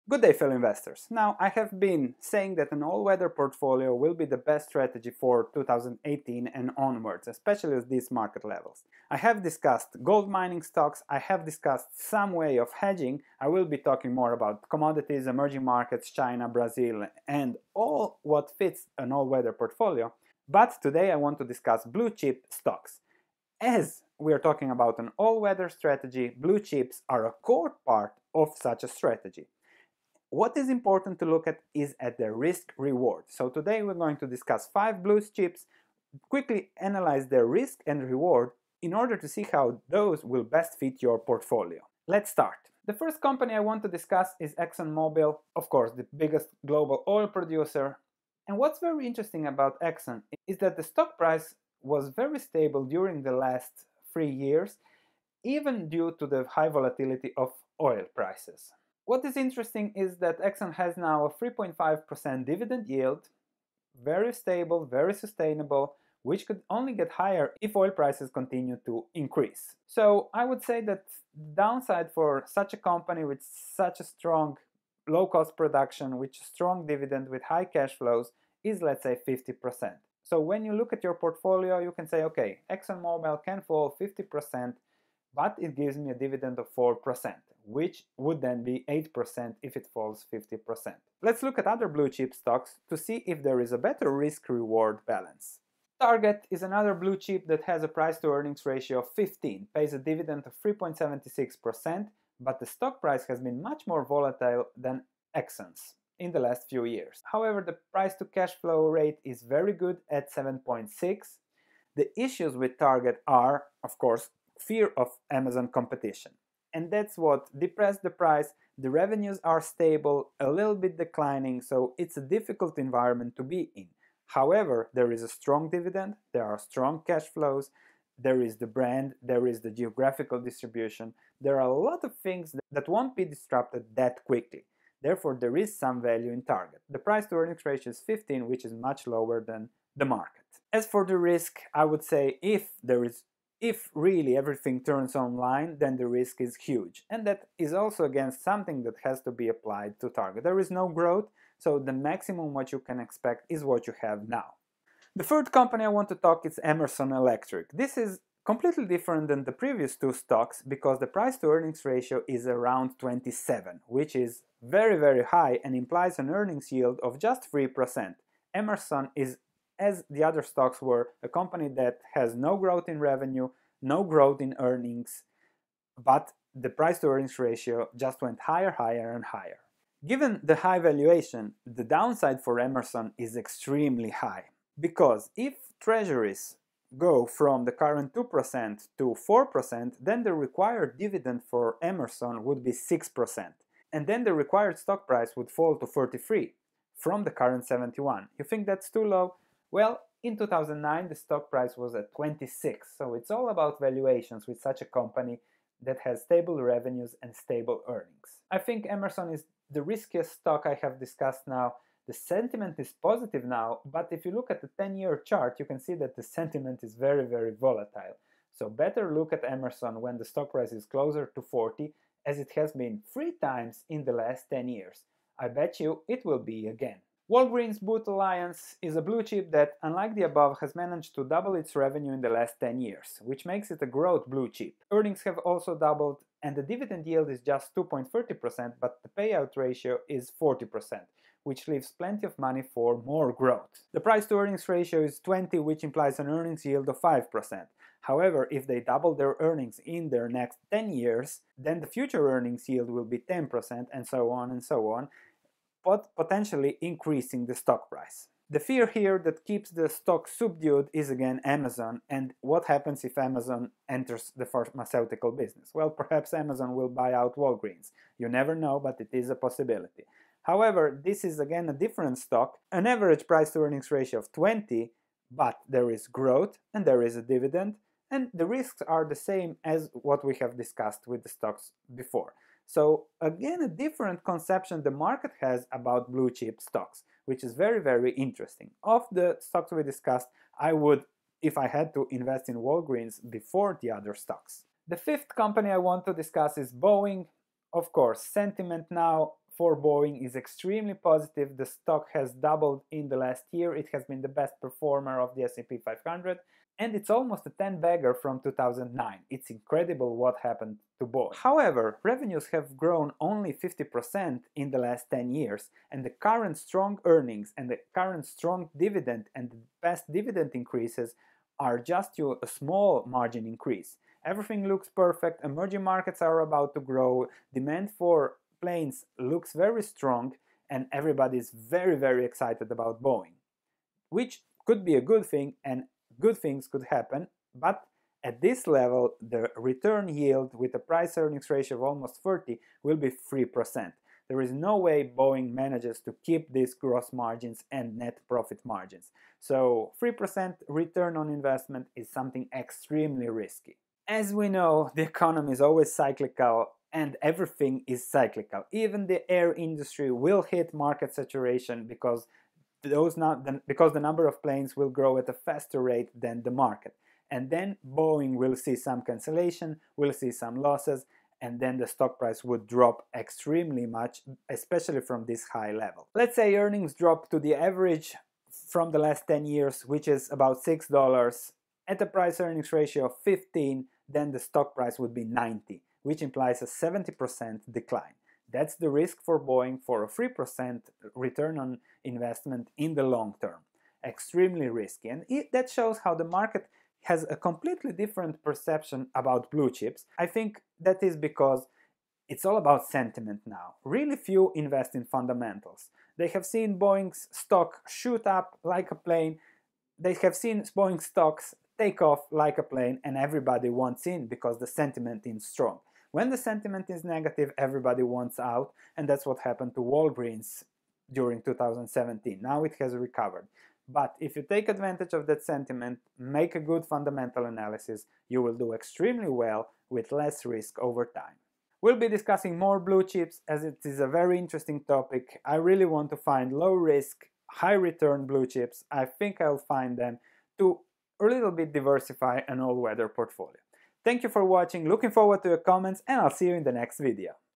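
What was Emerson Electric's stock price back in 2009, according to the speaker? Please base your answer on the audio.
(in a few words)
26.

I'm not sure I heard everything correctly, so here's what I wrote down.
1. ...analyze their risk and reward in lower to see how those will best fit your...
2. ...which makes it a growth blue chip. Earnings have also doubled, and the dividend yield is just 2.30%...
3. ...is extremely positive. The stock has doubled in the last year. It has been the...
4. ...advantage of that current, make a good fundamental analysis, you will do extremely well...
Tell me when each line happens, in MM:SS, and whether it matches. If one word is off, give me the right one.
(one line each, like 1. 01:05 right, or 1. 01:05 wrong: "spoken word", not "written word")
1. 00:36 wrong: "order", not "lower"
2. 03:53 right
3. 05:00 right
4. 07:04 wrong: "sentiment", not "current".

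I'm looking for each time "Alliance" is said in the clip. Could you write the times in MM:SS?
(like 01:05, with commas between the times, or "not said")
03:48.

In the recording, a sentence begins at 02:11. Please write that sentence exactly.
There are a lot of things that won't be disrupted that quickly.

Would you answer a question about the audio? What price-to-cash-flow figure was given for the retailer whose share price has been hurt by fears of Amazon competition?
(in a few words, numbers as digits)
7.6.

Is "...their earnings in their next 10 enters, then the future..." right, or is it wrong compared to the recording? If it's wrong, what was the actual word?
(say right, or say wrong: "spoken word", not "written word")
wrong: "years", not "enters".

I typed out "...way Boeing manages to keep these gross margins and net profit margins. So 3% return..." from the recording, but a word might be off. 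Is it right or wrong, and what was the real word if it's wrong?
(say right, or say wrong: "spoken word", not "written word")
right.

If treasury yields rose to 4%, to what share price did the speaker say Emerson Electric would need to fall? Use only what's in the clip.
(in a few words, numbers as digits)
43.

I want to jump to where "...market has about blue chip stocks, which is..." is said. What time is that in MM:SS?
04:44.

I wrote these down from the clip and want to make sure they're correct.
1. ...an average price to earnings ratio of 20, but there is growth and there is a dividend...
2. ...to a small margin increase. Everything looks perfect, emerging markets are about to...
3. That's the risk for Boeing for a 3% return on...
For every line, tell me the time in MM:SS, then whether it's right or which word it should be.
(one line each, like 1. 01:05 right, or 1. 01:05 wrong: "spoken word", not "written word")
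1. 04:32 right
2. 05:22 right
3. 06:28 right.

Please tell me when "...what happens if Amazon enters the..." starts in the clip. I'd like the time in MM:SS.
04:22.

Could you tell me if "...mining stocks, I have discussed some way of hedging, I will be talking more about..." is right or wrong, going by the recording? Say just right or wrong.
right.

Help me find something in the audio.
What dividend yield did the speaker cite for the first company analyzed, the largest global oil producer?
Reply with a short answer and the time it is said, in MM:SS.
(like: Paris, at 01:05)
3.5%, at 01:01.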